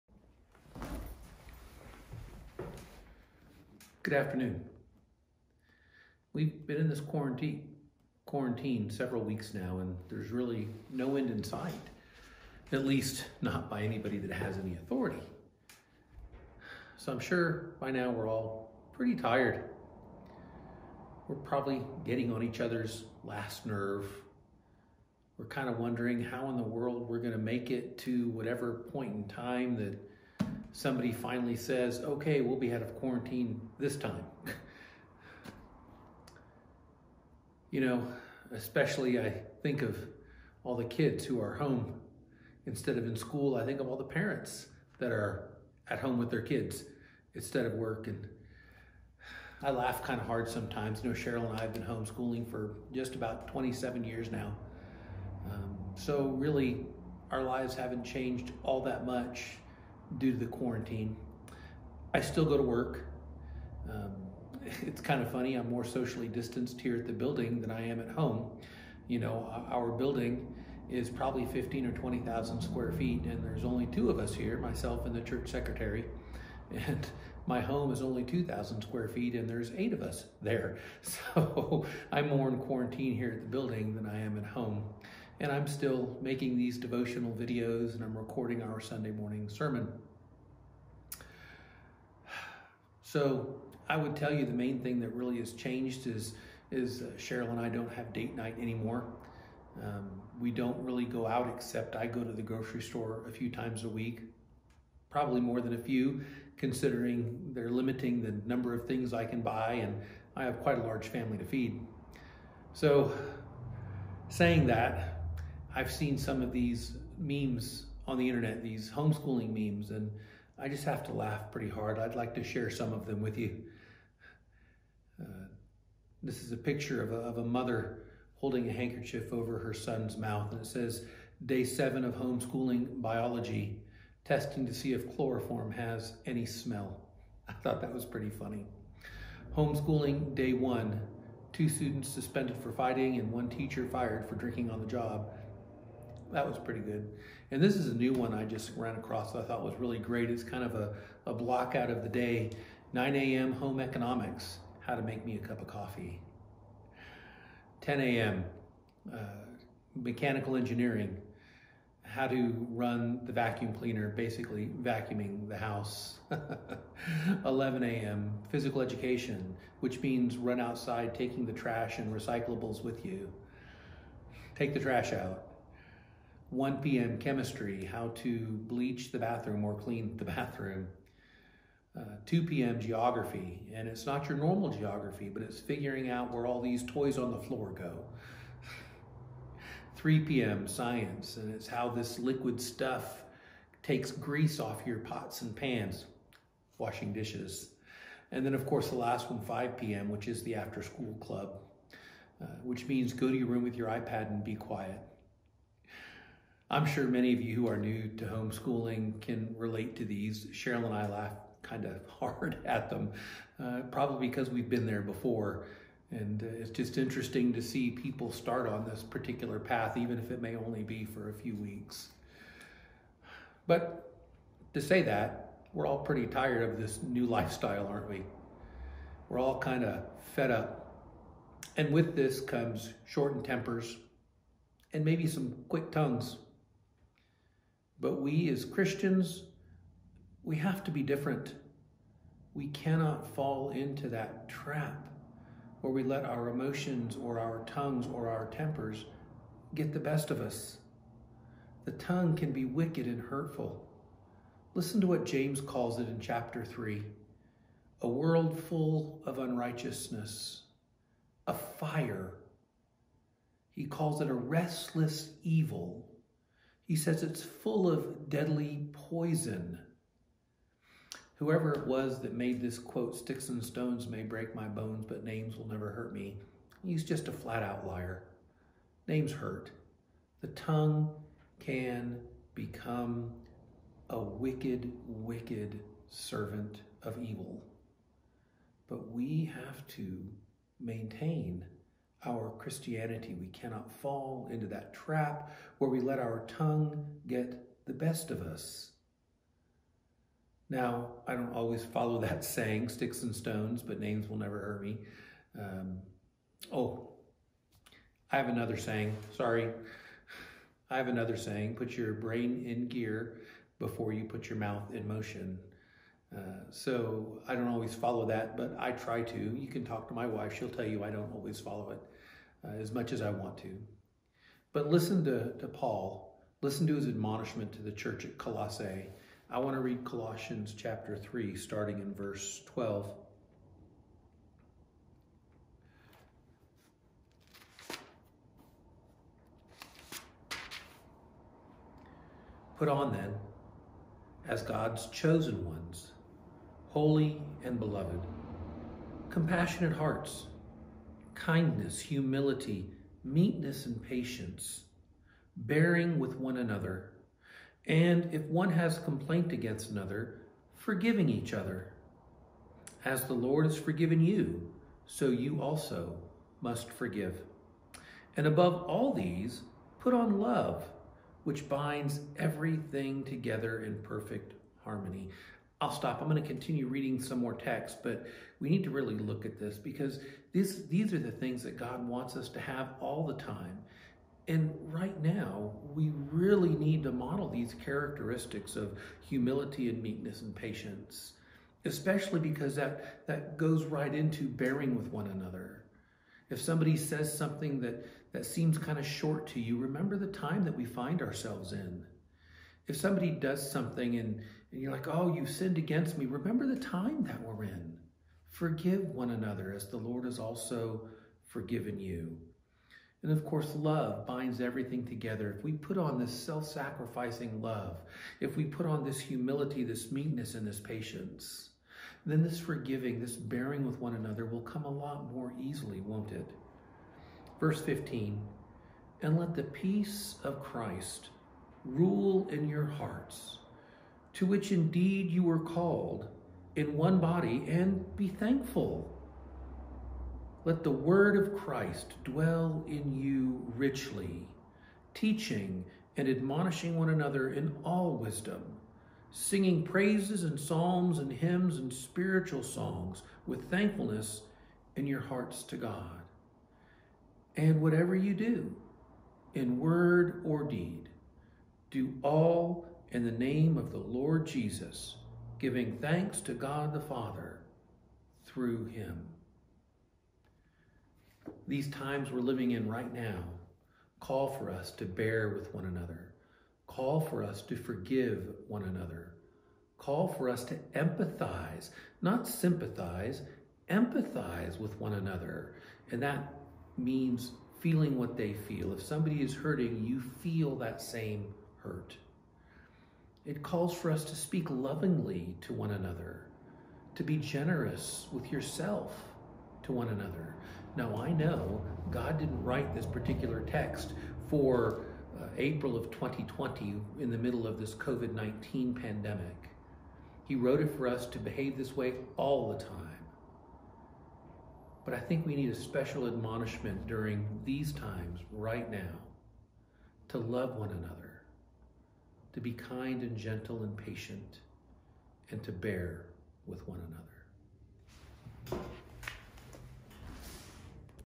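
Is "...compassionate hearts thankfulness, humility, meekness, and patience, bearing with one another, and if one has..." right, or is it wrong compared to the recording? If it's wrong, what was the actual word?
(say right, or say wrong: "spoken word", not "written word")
wrong: "kindness", not "thankfulness".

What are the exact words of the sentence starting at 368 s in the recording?
And above all these, put on love, which binds everything together in perfect harmony.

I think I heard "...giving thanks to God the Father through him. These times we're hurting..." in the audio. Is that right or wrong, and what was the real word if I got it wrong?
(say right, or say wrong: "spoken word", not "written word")
wrong: "living", not "hurting".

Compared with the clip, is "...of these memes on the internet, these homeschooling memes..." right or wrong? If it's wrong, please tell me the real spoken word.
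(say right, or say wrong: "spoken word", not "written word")
right.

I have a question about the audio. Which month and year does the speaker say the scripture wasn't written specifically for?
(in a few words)
April 2020.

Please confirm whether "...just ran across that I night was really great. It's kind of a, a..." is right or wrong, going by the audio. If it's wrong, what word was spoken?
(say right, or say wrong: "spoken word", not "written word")
wrong: "thought", not "night".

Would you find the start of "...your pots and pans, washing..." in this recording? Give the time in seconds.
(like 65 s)
194 s.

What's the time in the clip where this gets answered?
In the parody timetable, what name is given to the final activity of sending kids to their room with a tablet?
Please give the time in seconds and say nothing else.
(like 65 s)
200 s.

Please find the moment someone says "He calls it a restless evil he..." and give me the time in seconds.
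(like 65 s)
263 s.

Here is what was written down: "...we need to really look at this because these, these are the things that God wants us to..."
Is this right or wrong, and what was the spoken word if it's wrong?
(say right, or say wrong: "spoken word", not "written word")
right.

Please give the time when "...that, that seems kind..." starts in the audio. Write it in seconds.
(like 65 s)
397 s.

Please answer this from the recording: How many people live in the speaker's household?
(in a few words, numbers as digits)
8.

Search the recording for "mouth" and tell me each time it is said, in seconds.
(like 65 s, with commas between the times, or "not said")
130 s, 314 s.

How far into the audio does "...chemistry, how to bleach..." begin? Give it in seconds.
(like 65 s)
177 s.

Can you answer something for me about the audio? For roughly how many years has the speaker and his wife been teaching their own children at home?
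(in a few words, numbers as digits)
27.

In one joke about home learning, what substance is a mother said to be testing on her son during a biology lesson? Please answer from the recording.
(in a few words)
chloroform.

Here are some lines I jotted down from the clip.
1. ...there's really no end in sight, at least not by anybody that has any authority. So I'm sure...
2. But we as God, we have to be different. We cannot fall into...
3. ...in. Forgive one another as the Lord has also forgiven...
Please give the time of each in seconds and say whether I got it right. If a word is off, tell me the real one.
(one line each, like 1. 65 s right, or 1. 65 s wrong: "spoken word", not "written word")
1. 10 s right
2. 238 s wrong: "Christians", not "God"
3. 407 s right.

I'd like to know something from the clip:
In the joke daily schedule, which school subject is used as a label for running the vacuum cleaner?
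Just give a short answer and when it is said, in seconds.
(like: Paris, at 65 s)
mechanical engineering, at 159 s.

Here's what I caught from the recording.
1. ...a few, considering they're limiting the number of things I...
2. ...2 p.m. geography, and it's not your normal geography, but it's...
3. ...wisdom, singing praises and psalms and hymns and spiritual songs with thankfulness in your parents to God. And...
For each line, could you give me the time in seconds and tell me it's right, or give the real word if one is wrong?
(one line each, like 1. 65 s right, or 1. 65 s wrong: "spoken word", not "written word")
1. 105 s right
2. 182 s right
3. 448 s wrong: "hearts", not "parents".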